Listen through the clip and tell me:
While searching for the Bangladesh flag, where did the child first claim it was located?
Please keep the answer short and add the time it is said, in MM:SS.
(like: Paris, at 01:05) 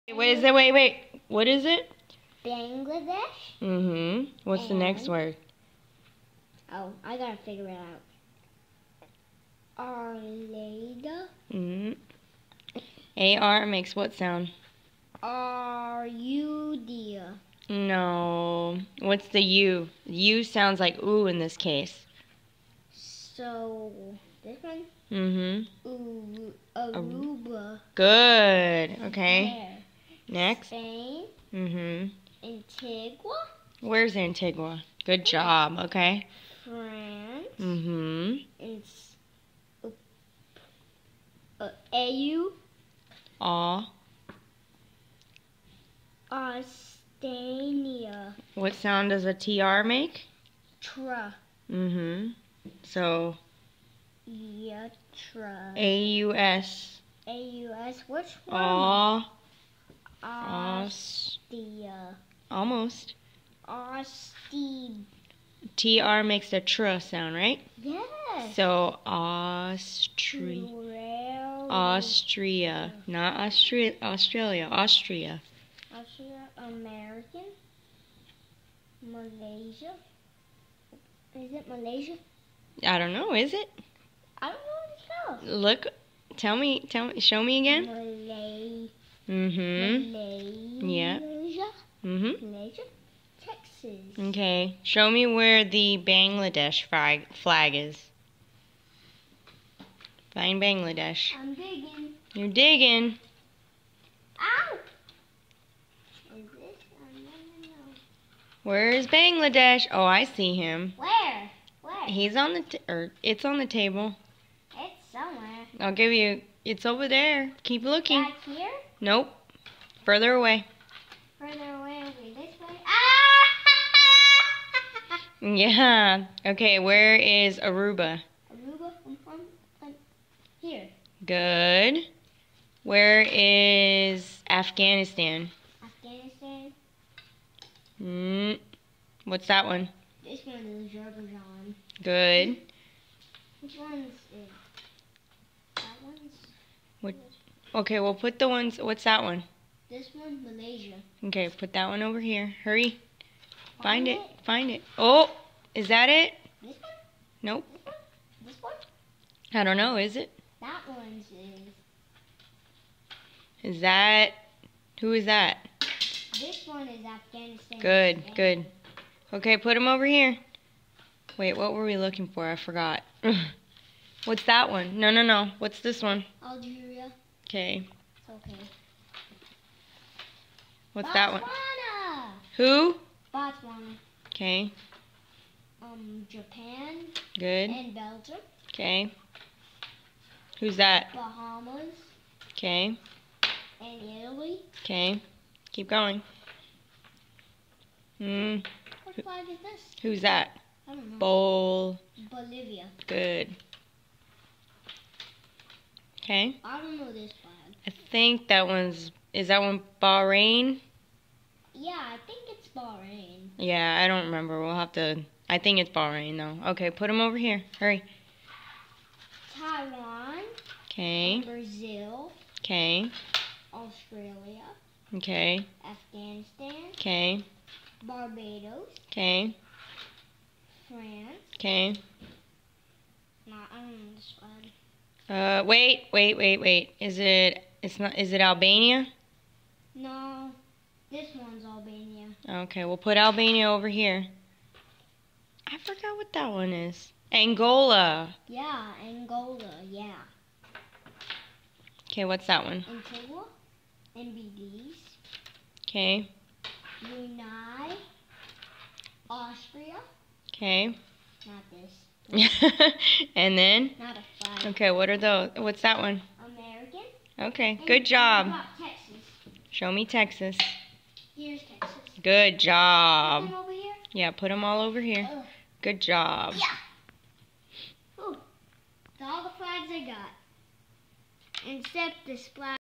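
on the table, at 01:53.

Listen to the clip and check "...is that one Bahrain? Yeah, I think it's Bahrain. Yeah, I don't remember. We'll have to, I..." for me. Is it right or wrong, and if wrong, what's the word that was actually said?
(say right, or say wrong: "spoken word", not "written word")
right.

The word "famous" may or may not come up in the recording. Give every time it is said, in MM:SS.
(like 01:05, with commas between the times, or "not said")
not said.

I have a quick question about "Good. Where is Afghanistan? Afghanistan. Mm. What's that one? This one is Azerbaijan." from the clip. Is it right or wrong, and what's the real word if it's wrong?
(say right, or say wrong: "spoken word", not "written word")
right.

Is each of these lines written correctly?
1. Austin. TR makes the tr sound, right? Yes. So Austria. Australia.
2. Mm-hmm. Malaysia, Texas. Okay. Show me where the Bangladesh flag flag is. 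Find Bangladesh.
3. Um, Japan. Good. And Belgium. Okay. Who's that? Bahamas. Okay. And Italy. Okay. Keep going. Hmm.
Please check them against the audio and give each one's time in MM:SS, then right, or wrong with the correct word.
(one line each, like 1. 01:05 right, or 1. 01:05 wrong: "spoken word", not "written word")
1. 01:03 right
2. 01:32 right
3. 03:05 right.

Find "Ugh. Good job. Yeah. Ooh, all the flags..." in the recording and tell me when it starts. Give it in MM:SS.
04:35.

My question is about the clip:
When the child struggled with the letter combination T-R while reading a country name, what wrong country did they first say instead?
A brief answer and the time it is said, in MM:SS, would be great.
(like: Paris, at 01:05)
Austania, at 00:46.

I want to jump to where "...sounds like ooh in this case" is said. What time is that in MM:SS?
00:20.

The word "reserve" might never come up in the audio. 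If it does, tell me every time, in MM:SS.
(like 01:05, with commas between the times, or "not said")
not said.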